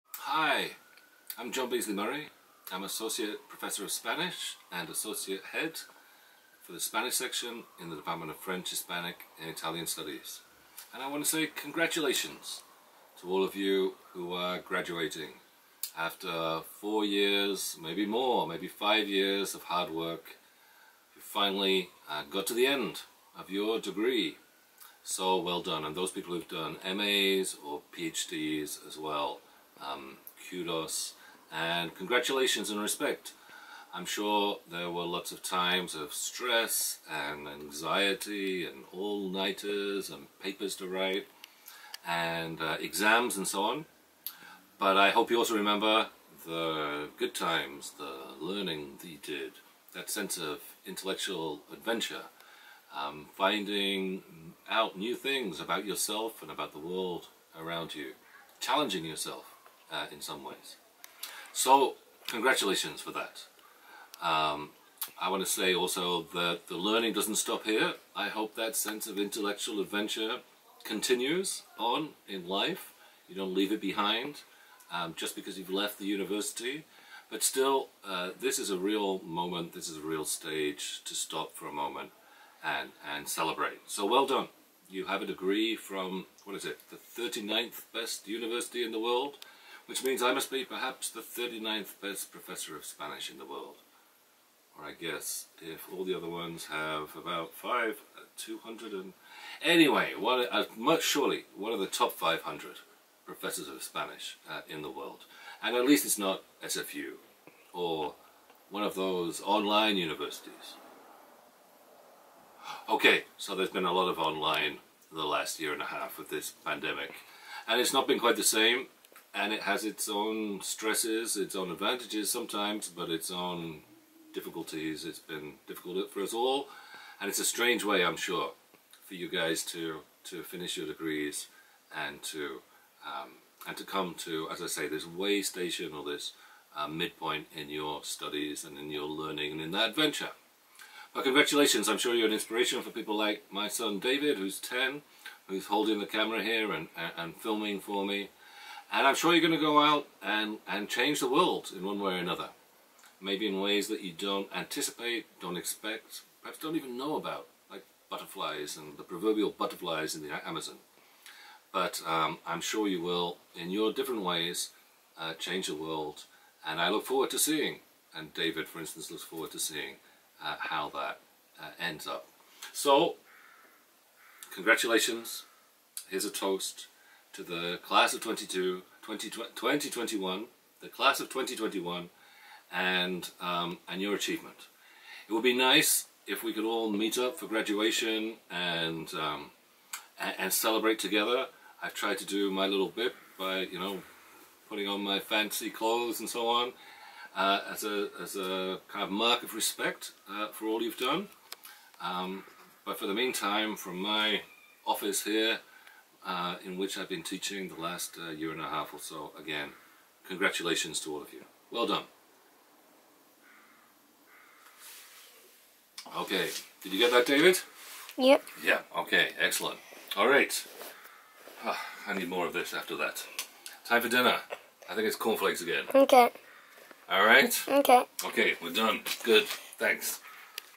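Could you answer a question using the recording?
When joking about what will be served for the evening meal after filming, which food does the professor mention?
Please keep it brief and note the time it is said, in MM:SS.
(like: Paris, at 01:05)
Cornflakes, at 03:45.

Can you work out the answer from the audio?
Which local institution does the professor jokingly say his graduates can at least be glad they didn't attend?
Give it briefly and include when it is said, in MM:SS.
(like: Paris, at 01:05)
SFU, at 01:46.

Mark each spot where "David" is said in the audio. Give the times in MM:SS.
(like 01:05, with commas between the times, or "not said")
02:23, 02:48, 03:37.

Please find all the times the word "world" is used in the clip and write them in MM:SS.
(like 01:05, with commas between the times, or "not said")
00:56, 01:28, 01:33, 01:44, 02:31, 02:45.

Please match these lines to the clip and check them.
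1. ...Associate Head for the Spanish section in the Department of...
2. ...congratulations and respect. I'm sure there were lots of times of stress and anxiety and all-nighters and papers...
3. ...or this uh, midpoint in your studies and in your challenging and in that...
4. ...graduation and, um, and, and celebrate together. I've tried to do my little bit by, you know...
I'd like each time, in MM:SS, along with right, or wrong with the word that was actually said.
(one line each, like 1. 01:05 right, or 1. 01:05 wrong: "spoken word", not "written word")
1. 00:04 right
2. 00:31 right
3. 02:15 wrong: "learning", not "challenging"
4. 03:07 right.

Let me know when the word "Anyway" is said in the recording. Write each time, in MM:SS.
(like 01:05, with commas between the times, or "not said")
01:39.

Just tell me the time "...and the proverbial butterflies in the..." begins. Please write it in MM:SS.
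02:38.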